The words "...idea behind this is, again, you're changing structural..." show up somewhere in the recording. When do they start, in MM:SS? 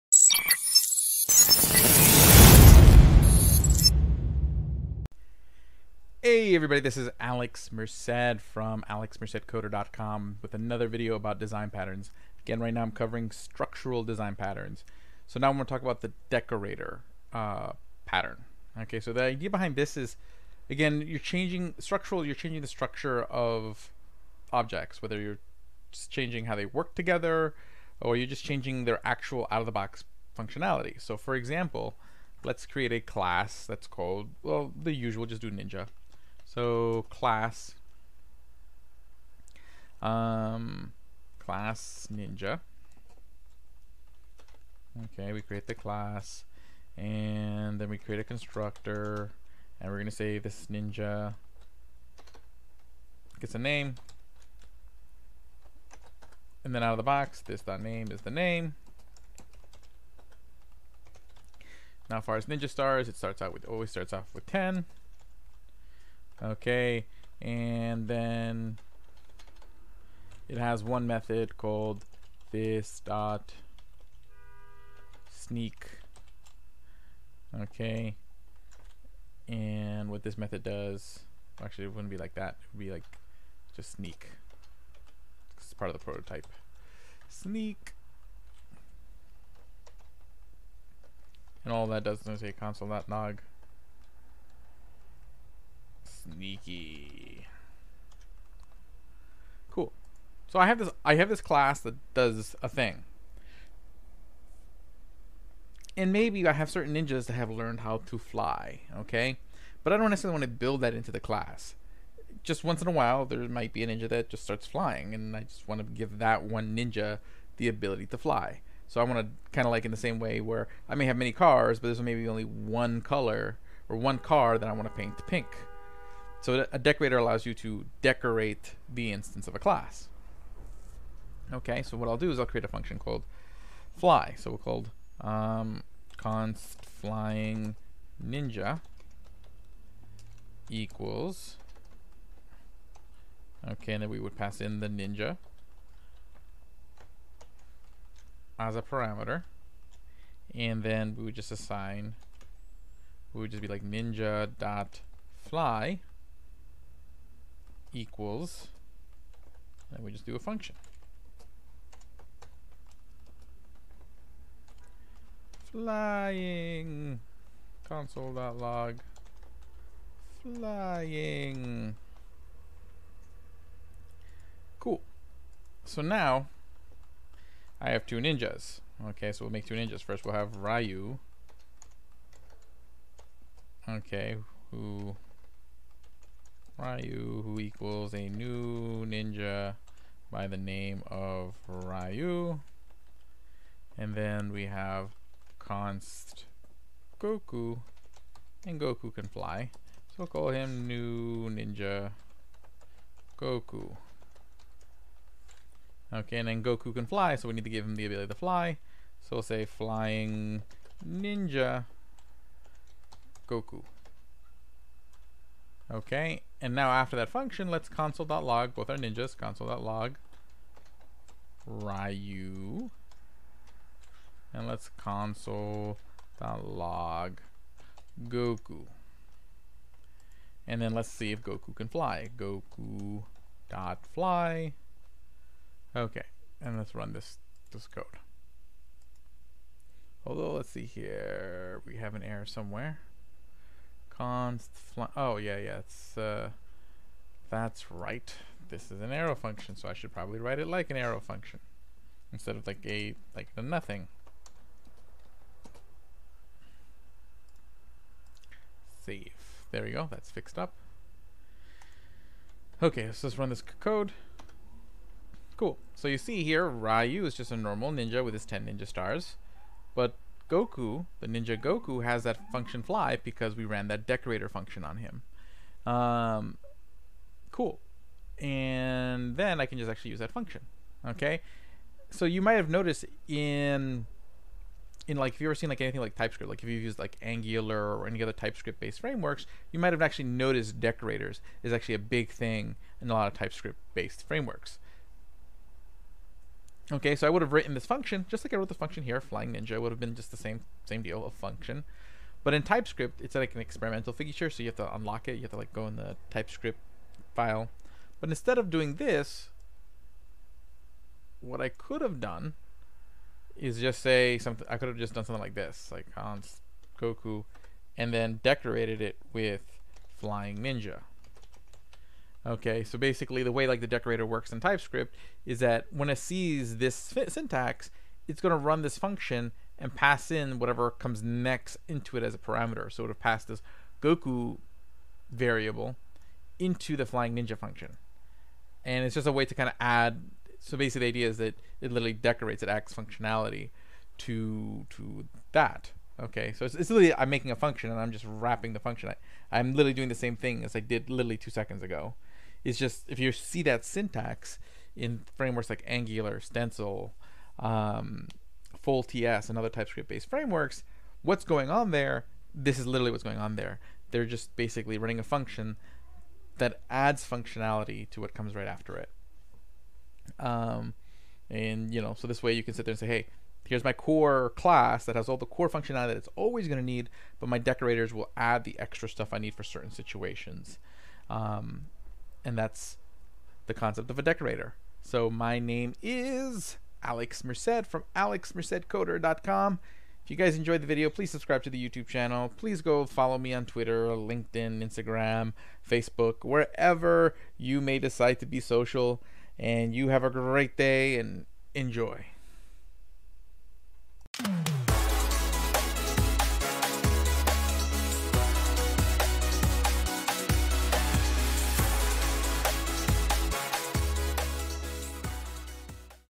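00:19.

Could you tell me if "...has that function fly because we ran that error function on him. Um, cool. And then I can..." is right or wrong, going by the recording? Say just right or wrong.
wrong.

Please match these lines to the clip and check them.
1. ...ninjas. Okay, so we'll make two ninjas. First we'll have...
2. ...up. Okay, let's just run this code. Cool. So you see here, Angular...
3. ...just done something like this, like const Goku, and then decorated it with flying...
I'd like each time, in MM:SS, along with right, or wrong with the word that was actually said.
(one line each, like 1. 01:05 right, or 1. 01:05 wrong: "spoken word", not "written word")
1. 02:58 right
2. 04:20 wrong: "Ryu", not "Angular"
3. 05:14 right.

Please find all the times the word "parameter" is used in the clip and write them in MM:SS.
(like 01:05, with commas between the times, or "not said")
02:28, 05:32.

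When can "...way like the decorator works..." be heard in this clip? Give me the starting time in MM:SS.
05:23.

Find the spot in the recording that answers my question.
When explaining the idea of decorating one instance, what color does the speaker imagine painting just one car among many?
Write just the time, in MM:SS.
02:05.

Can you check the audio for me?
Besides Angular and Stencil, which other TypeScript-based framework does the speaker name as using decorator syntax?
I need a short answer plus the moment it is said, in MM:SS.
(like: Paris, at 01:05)
FoalTS, at 05:58.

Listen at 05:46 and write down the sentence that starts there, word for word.
Okay, so it's, it's, literally I'm making a function and I'm just wrapping the function.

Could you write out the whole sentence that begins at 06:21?
Um, and that's the concept of a decorator.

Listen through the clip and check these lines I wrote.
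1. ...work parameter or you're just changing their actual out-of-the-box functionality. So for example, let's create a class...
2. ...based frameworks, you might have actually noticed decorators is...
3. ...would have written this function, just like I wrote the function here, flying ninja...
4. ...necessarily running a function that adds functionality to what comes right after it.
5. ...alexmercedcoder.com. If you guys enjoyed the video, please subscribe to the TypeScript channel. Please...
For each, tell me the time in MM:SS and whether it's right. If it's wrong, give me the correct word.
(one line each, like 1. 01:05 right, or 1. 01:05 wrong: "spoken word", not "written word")
1. 00:26 wrong: "together", not "parameter"
2. 04:48 right
3. 04:57 right
4. 06:04 wrong: "basically", not "necessarily"
5. 06:28 wrong: "YouTube", not "TypeScript".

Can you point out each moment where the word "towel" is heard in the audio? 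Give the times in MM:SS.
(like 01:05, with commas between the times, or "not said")
not said.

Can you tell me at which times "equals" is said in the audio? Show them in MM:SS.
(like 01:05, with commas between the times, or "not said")
02:20, 02:37, 03:07.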